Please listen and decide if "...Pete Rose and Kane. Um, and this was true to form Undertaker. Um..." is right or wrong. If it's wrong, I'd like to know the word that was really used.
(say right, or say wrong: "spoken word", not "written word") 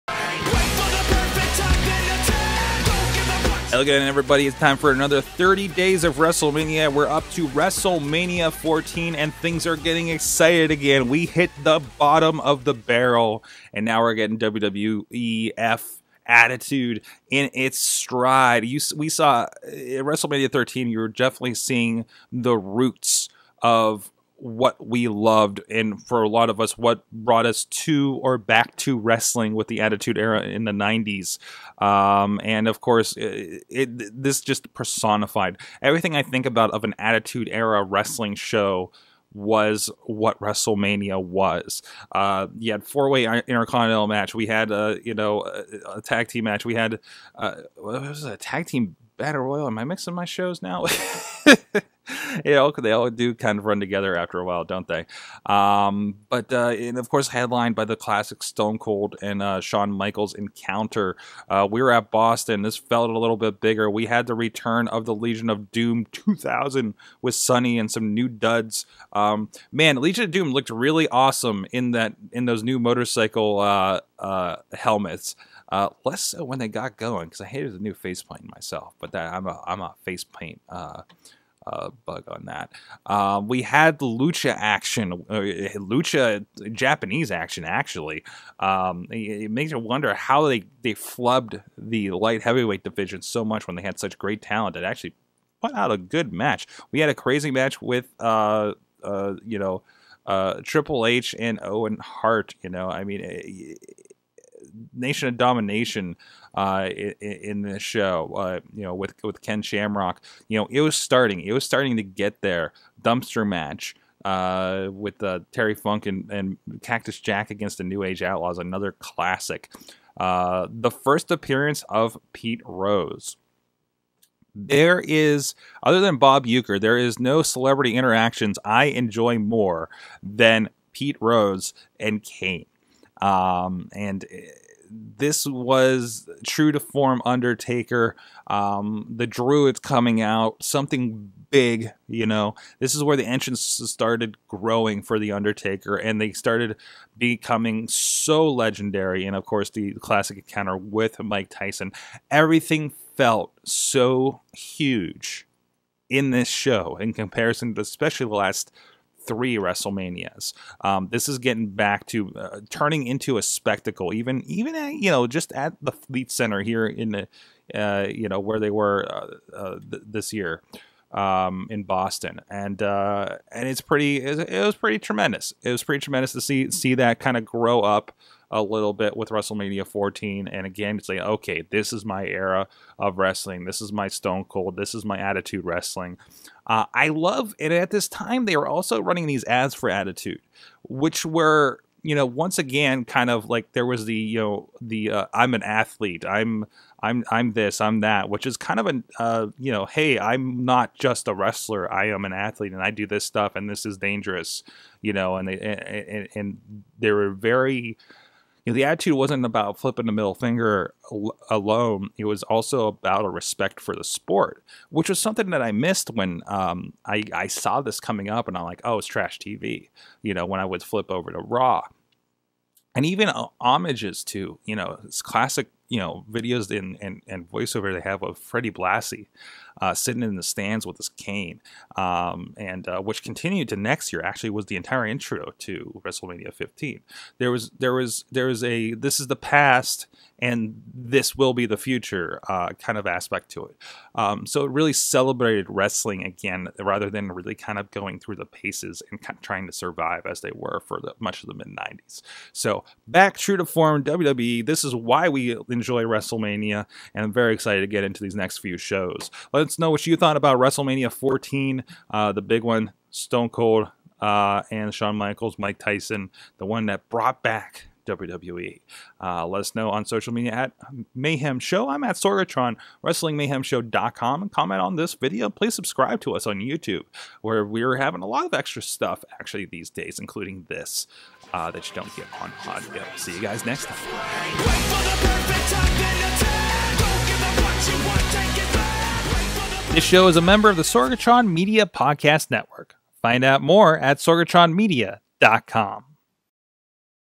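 right.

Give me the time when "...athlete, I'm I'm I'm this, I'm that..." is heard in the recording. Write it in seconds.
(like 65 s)
195 s.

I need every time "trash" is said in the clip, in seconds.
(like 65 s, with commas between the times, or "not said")
219 s.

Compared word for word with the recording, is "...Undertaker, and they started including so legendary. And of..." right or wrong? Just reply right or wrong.
wrong.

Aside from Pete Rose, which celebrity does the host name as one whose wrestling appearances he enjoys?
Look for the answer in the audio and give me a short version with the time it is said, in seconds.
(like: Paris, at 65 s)
Bob Uecker, at 126 s.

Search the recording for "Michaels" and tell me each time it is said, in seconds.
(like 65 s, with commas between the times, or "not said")
59 s, 265 s.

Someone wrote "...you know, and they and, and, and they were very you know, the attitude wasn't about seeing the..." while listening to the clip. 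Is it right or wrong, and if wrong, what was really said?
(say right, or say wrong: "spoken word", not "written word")
wrong: "flipping", not "seeing".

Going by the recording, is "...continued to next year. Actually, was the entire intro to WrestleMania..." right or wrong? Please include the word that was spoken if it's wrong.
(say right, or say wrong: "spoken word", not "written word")
right.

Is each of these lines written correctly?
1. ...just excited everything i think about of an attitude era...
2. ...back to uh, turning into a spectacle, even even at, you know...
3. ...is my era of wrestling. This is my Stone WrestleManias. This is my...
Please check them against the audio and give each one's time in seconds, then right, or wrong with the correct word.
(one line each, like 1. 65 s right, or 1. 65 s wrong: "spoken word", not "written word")
1. 34 s wrong: "personified", not "excited"
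2. 161 s right
3. 181 s wrong: "Cold", not "WrestleManias".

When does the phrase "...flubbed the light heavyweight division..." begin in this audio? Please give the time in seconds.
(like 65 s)
90 s.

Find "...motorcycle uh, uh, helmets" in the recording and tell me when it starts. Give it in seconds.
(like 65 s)
72 s.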